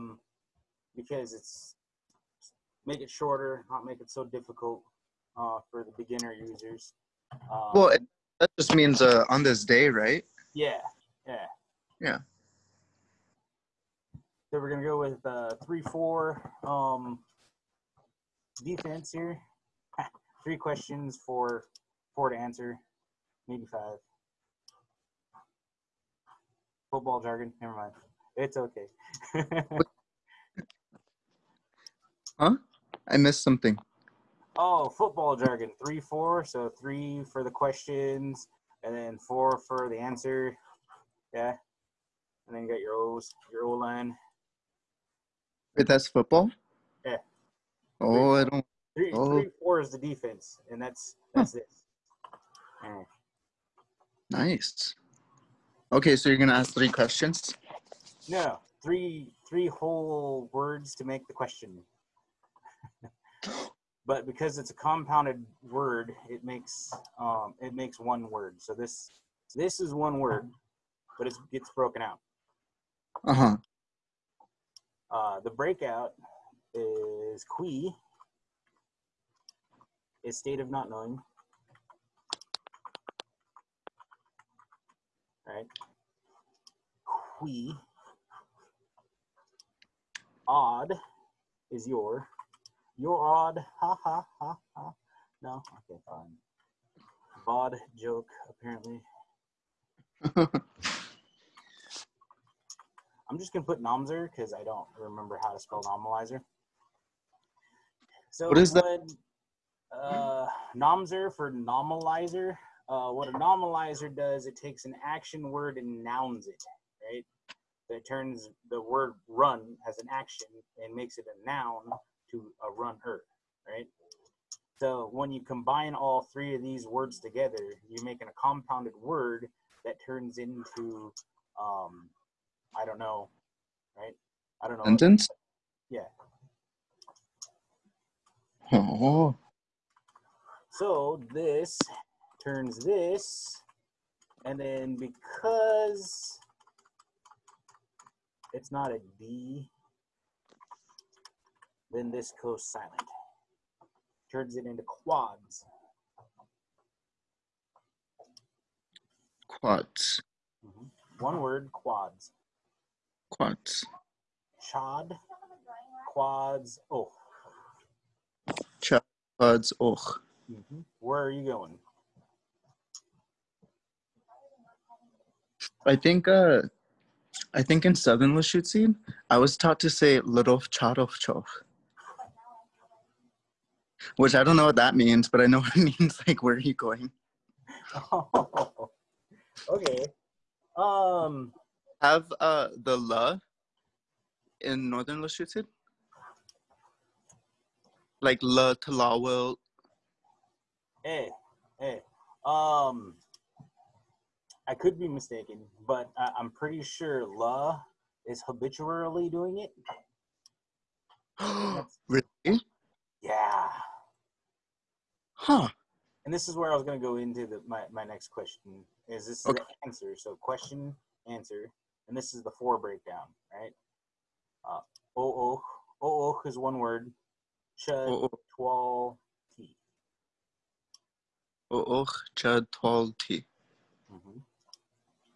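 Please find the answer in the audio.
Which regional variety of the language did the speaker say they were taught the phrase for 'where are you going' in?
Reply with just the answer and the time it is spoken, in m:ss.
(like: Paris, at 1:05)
Southern Lushootseed, at 2:57.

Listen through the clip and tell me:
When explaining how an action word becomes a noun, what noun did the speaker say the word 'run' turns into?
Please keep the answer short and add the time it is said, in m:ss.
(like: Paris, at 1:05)
Runner, at 2:02.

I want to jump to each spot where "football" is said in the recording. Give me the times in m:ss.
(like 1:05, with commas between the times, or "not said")
0:26, 0:34, 0:46.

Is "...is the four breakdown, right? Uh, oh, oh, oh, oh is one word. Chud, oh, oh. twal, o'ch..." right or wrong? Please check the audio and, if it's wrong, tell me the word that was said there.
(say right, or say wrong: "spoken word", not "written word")
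right.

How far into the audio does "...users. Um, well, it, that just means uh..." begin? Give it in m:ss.
0:06.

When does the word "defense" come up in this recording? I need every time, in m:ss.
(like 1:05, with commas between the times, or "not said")
0:18, 0:49.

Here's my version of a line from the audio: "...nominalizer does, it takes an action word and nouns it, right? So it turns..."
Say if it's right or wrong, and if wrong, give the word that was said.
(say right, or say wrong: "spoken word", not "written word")
right.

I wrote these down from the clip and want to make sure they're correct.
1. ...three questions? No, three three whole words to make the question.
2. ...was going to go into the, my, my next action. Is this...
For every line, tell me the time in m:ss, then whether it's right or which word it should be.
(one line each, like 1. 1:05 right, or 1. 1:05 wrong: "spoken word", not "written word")
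1. 0:56 right
2. 3:36 wrong: "question", not "action".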